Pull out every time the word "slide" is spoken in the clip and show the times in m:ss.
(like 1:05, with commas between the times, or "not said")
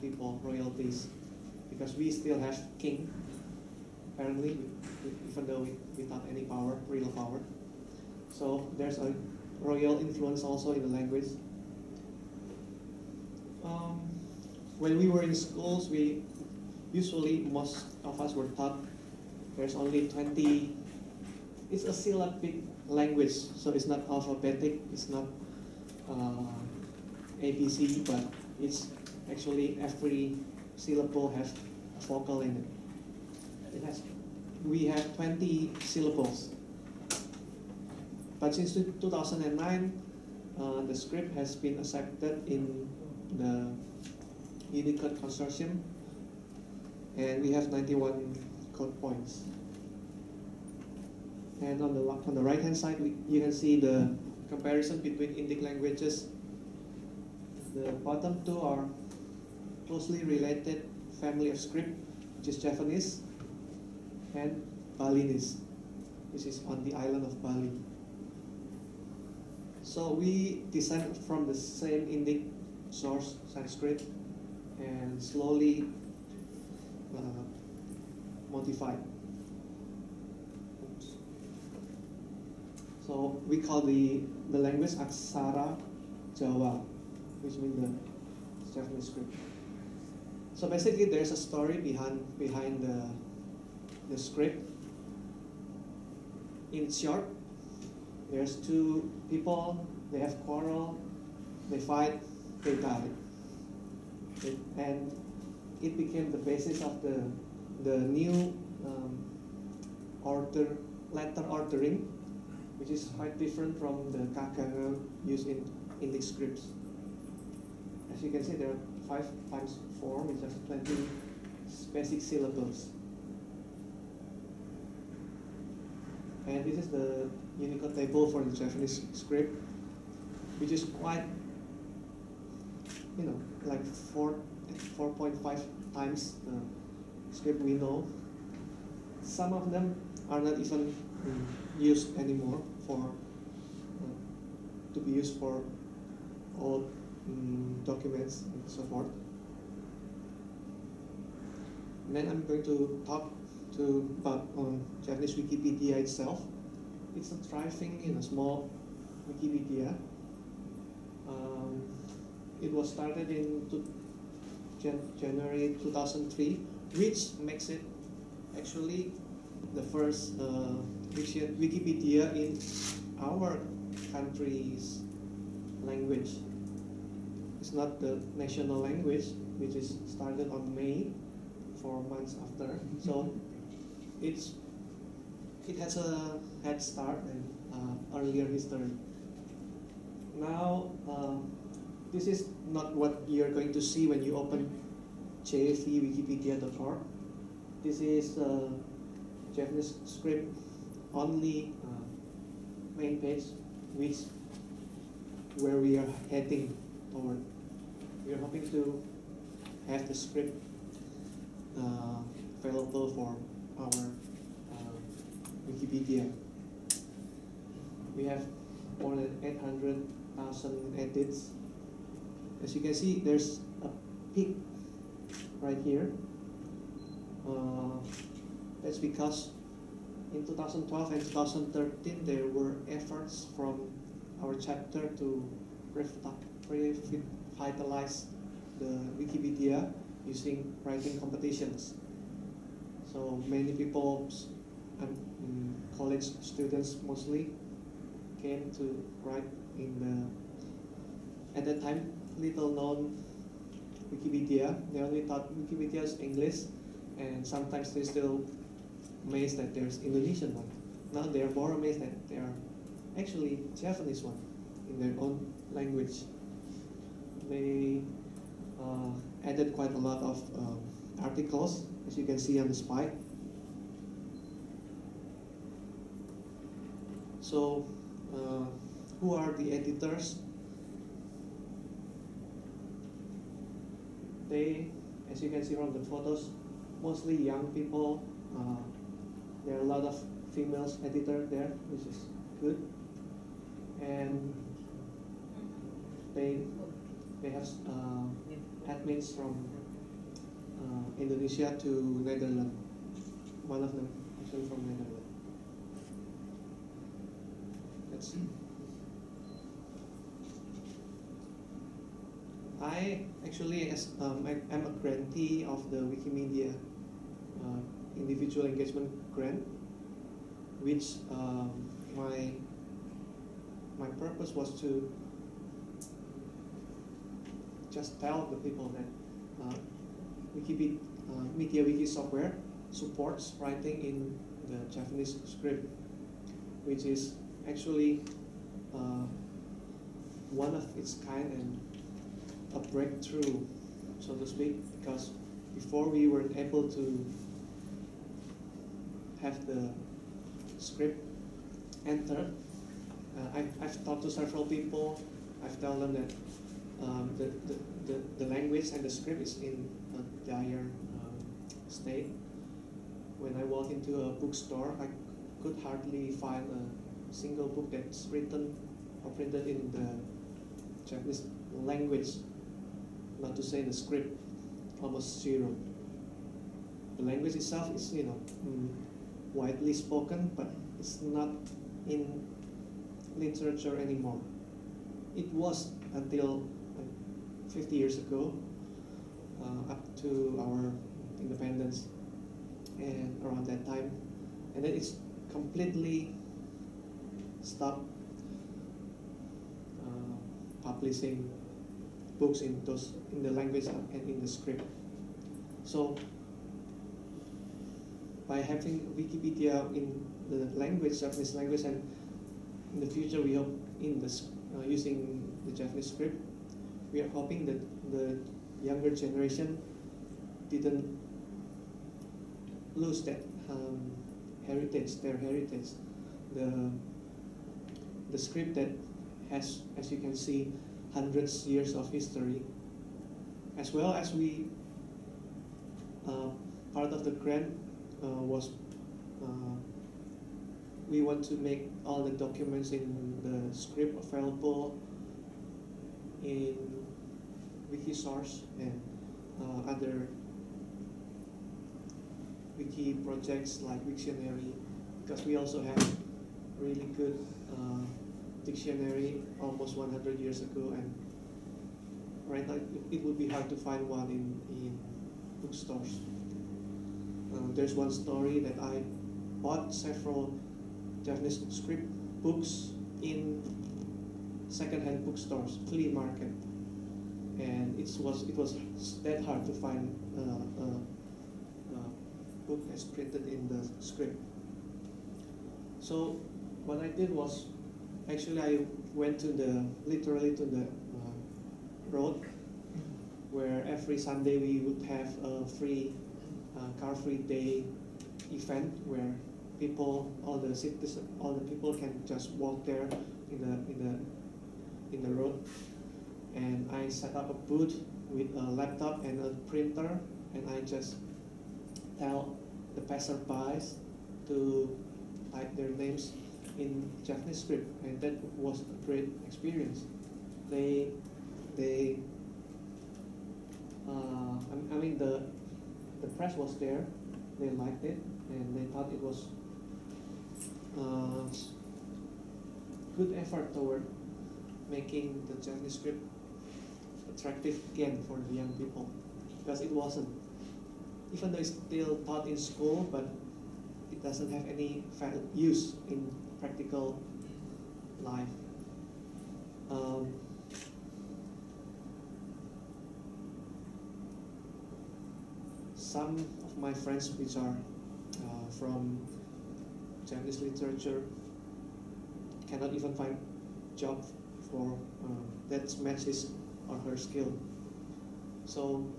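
4:32.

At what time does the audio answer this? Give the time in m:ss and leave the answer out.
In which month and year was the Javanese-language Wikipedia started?
2:45.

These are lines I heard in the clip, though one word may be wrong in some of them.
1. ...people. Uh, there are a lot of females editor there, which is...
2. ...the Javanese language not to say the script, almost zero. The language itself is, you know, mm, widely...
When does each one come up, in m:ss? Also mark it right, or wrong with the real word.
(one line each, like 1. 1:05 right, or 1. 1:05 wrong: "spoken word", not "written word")
1. 4:47 right
2. 6:09 right.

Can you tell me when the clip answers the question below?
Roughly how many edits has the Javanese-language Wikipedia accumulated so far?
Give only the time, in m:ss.
3:39.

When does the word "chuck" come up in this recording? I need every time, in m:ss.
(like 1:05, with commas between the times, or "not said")
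not said.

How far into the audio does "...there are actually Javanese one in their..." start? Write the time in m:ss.
4:22.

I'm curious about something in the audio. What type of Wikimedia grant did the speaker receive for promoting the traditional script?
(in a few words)
Individual Engagement Grant.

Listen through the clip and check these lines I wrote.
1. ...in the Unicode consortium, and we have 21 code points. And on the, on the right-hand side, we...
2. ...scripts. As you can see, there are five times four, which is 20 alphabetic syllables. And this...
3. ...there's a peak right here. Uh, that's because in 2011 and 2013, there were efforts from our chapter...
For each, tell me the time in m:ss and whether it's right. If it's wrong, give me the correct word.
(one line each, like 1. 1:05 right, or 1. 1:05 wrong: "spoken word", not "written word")
1. 0:42 wrong: "91", not "21"
2. 1:56 wrong: "basic", not "alphabetic"
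3. 3:43 wrong: "2012", not "2011".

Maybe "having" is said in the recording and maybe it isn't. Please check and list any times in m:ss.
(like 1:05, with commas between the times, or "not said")
6:48.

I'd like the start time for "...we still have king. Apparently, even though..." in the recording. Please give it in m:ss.
0:01.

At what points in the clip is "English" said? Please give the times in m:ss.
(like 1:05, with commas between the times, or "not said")
1:56, 4:16.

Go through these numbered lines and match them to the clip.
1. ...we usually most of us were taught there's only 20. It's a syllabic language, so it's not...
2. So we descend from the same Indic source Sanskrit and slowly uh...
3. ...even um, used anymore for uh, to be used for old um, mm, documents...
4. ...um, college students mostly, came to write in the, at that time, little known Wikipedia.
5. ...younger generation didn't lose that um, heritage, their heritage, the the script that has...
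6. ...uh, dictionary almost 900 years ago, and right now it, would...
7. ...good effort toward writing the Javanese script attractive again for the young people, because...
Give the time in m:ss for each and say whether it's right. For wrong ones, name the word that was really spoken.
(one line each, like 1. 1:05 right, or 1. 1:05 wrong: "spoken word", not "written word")
1. 0:15 right
2. 1:09 right
3. 2:20 right
4. 4:05 right
5. 6:58 right
6. 7:37 wrong: "100", not "900"
7. 8:53 wrong: "making", not "writing".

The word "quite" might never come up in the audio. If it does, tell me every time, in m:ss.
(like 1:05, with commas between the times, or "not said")
1:53, 2:10, 4:29.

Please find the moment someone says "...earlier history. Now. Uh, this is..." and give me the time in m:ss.
3:08.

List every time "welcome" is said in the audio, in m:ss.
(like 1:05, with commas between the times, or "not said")
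not said.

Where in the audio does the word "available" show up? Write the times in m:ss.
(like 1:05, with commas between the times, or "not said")
3:32, 7:24.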